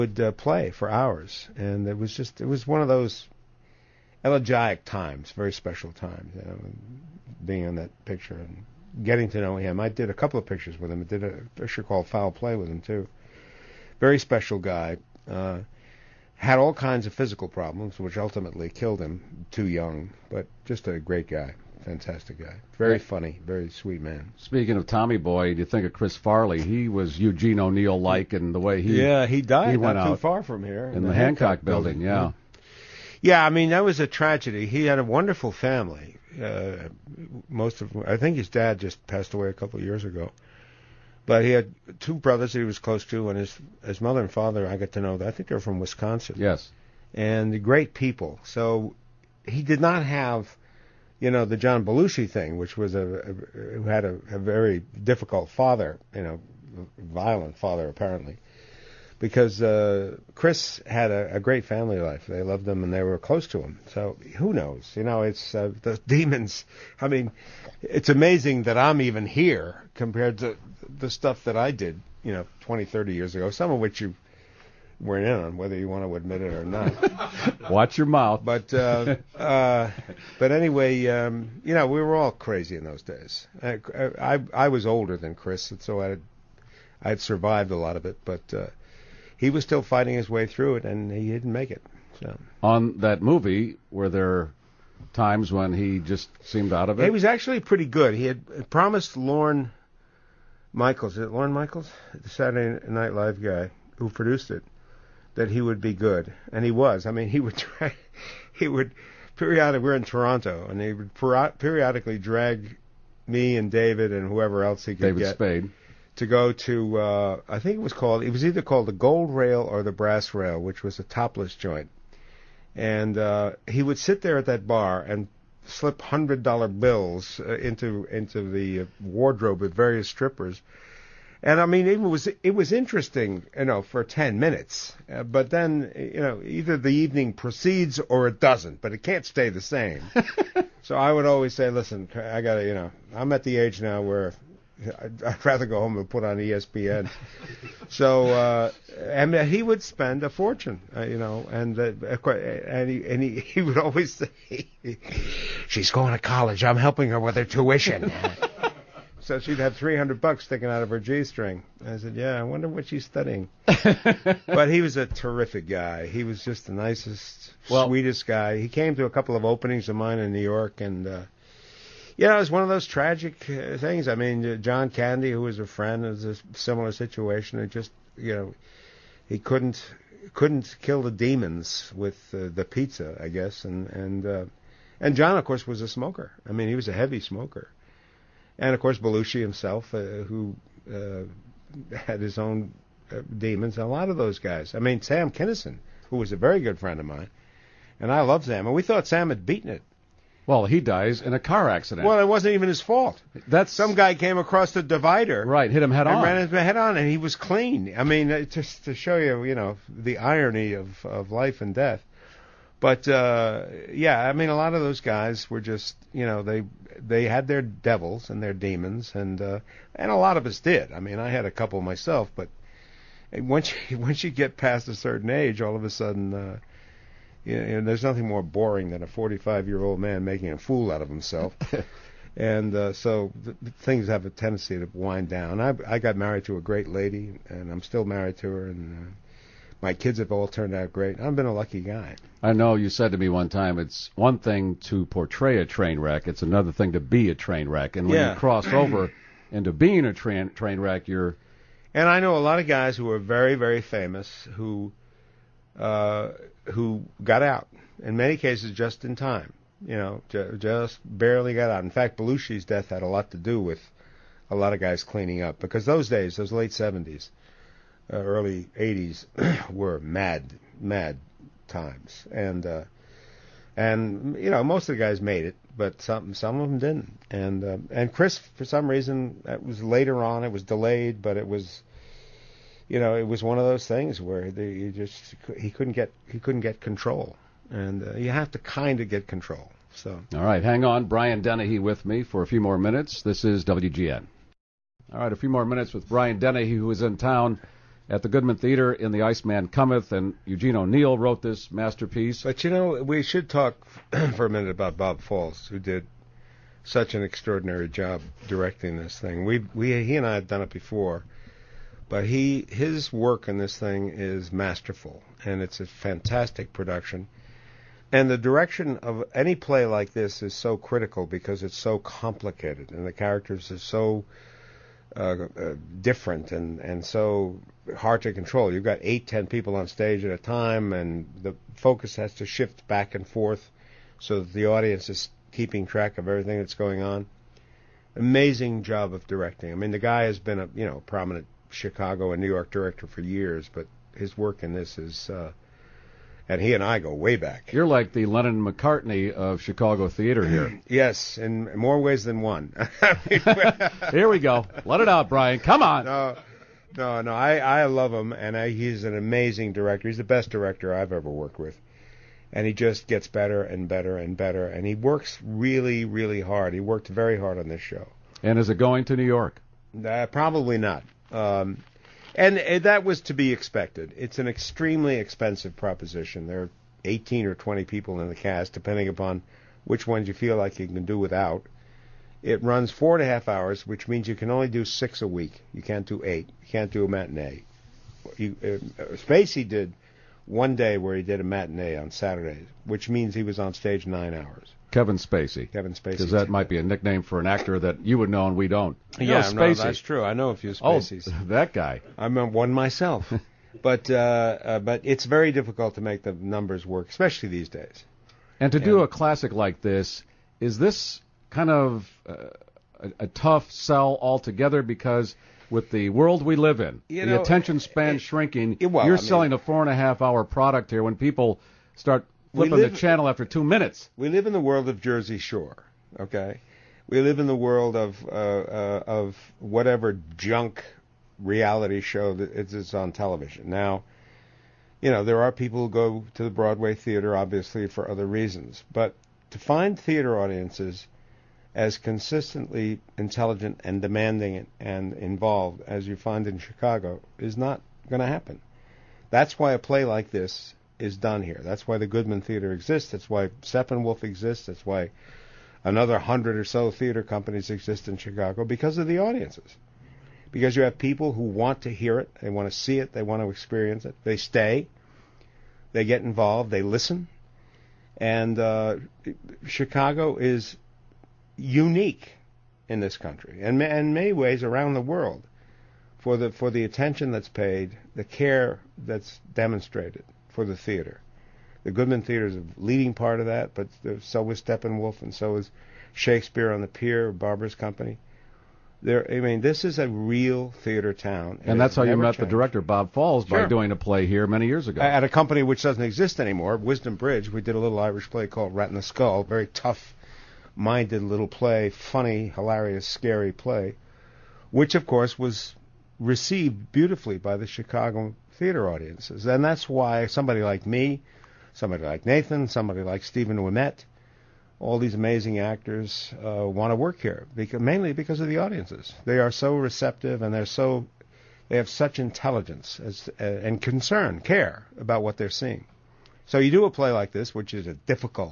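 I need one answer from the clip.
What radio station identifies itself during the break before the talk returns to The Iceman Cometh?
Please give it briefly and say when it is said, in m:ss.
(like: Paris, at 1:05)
WGN, at 4:53.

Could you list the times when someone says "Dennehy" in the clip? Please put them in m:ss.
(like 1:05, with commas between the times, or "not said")
4:51, 4:56.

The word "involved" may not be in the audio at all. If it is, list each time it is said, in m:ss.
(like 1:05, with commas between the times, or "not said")
7:25, 7:46.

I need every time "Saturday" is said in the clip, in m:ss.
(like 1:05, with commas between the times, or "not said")
1:42, 6:32.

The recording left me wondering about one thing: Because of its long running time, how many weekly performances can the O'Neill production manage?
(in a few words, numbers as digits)
6.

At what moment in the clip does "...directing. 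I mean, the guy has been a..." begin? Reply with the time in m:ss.
5:39.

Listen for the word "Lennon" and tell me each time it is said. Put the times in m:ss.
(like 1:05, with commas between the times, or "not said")
5:48.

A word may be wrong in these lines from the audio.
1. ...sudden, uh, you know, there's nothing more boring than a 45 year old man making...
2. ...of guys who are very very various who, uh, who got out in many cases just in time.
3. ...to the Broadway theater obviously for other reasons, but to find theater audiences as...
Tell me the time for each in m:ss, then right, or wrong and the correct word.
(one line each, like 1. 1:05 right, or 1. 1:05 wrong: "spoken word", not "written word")
1. 3:45 right
2. 4:12 wrong: "famous", not "various"
3. 7:16 right.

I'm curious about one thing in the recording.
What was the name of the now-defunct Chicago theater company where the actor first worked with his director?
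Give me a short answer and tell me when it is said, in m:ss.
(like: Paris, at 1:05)
Wisdom Bridge, at 8:16.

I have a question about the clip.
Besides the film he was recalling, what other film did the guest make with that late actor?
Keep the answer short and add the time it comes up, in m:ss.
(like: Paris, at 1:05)
Foul Play, at 0:12.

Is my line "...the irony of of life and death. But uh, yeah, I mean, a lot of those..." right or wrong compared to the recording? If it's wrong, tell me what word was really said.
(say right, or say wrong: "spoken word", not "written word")
right.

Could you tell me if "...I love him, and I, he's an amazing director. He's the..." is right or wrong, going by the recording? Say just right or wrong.
right.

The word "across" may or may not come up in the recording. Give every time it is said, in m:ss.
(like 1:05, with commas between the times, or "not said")
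3:24.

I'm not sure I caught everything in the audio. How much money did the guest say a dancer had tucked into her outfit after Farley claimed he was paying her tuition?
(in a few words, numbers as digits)
$300.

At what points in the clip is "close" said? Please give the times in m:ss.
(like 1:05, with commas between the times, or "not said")
0:42, 1:03.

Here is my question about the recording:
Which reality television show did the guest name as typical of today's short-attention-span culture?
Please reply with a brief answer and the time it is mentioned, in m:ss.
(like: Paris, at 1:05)
Jersey Shore, at 7:05.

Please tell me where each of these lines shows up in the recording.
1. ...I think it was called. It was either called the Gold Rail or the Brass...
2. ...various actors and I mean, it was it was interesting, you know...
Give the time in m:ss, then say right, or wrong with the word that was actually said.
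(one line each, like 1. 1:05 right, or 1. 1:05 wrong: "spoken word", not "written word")
1. 1:57 right
2. 2:09 wrong: "strippers", not "actors".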